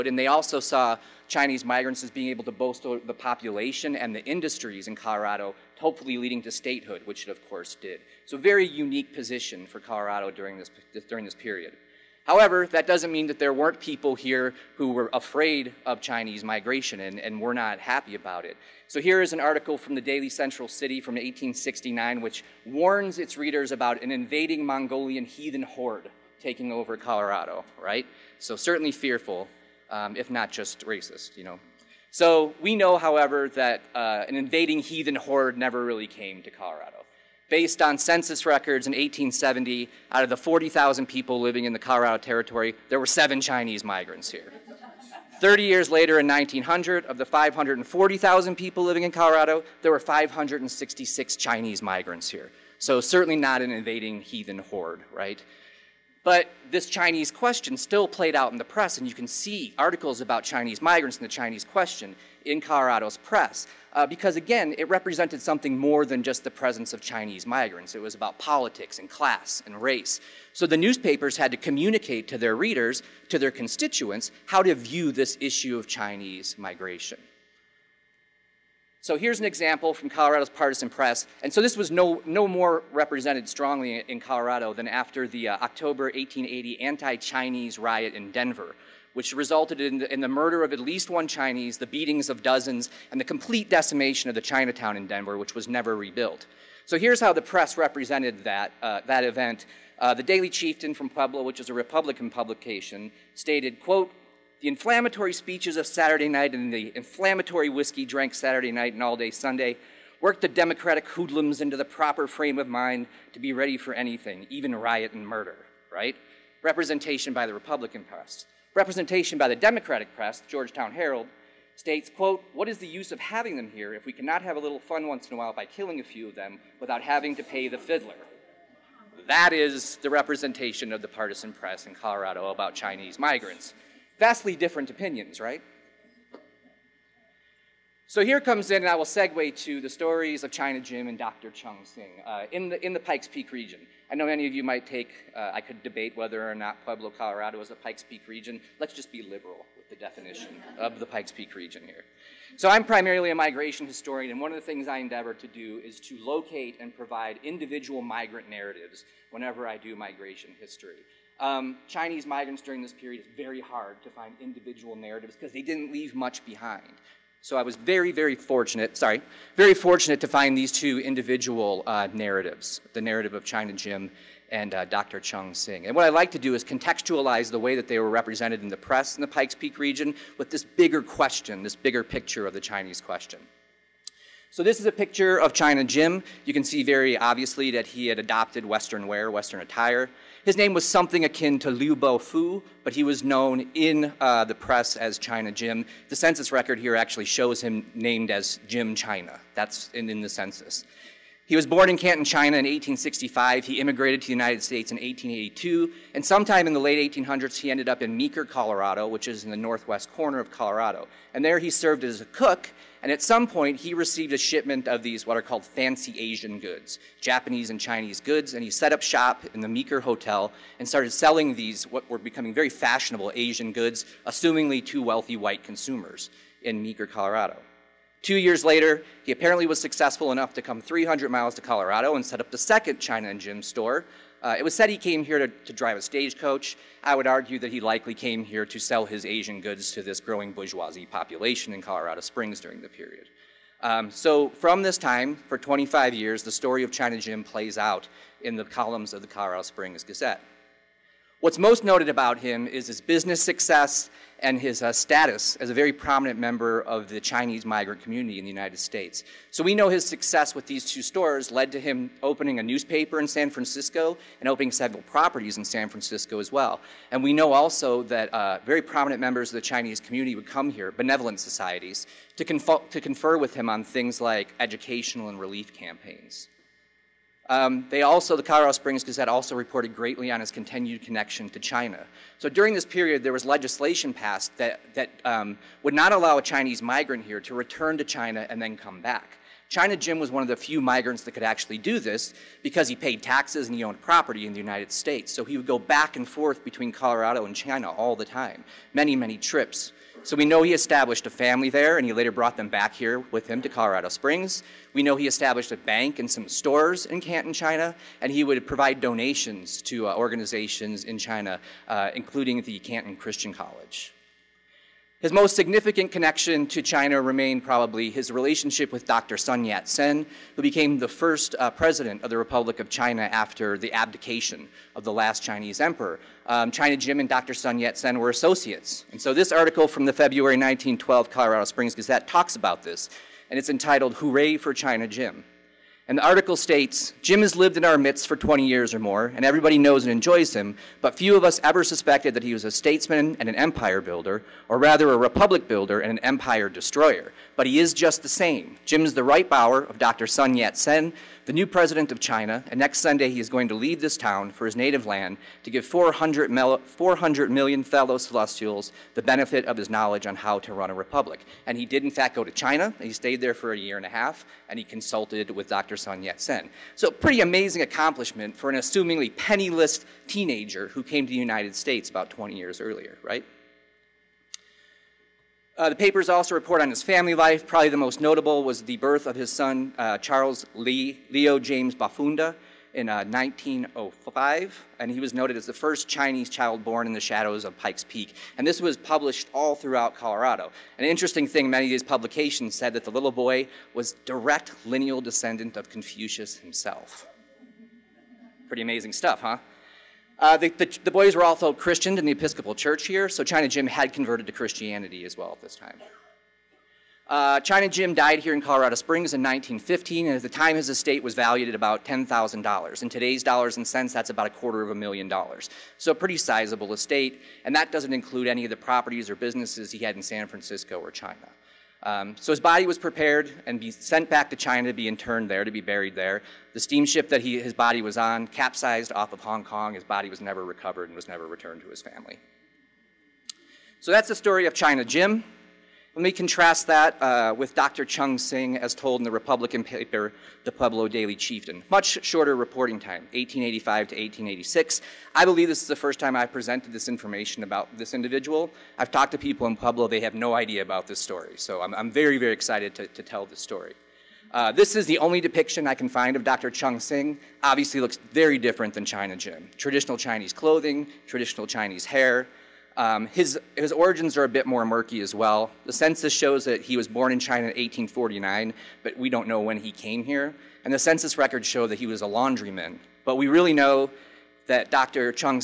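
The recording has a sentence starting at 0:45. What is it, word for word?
30 years later in 1900, of the 540,000 people living in Colorado, there were 566 Chinese migrants here.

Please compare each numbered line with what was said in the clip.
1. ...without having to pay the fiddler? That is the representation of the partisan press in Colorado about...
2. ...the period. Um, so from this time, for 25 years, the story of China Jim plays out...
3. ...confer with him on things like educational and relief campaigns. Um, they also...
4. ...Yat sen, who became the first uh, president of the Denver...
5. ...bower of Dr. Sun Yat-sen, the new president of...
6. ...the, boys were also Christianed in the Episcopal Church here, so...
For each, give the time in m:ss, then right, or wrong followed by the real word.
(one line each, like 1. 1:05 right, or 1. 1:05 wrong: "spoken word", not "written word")
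1. 2:06 right
2. 4:02 right
3. 4:33 right
4. 5:19 wrong: "Republic", not "Denver"
5. 5:49 right
6. 6:41 right.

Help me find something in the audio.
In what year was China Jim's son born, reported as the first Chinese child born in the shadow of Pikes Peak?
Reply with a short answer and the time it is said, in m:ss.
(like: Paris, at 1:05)
1905, at 6:23.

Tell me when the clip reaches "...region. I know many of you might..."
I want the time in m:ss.
2:23.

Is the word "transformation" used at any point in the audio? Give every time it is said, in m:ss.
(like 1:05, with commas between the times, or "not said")
not said.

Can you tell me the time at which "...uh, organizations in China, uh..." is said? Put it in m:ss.
5:10.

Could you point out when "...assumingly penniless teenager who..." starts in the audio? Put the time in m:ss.
6:08.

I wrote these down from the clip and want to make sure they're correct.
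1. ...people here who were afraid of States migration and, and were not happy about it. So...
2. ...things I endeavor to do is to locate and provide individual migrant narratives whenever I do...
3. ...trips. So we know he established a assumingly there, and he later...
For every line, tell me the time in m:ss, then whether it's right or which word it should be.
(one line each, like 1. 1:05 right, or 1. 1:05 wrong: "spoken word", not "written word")
1. 0:13 wrong: "Chinese", not "States"
2. 2:34 right
3. 4:59 wrong: "family", not "assumingly".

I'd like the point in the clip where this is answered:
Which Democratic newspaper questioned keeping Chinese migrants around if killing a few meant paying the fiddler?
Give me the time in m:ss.
2:00.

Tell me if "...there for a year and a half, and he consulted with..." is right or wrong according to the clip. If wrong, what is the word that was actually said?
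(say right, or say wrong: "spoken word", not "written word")
right.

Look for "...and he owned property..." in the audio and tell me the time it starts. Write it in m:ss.
4:53.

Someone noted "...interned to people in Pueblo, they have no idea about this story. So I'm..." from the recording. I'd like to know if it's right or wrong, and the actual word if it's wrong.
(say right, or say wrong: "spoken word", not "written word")
wrong: "talked", not "interned".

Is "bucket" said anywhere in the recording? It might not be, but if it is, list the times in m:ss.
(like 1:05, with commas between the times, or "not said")
not said.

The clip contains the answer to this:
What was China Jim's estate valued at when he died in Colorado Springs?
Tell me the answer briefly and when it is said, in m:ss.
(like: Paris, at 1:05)
$10,000, at 6:52.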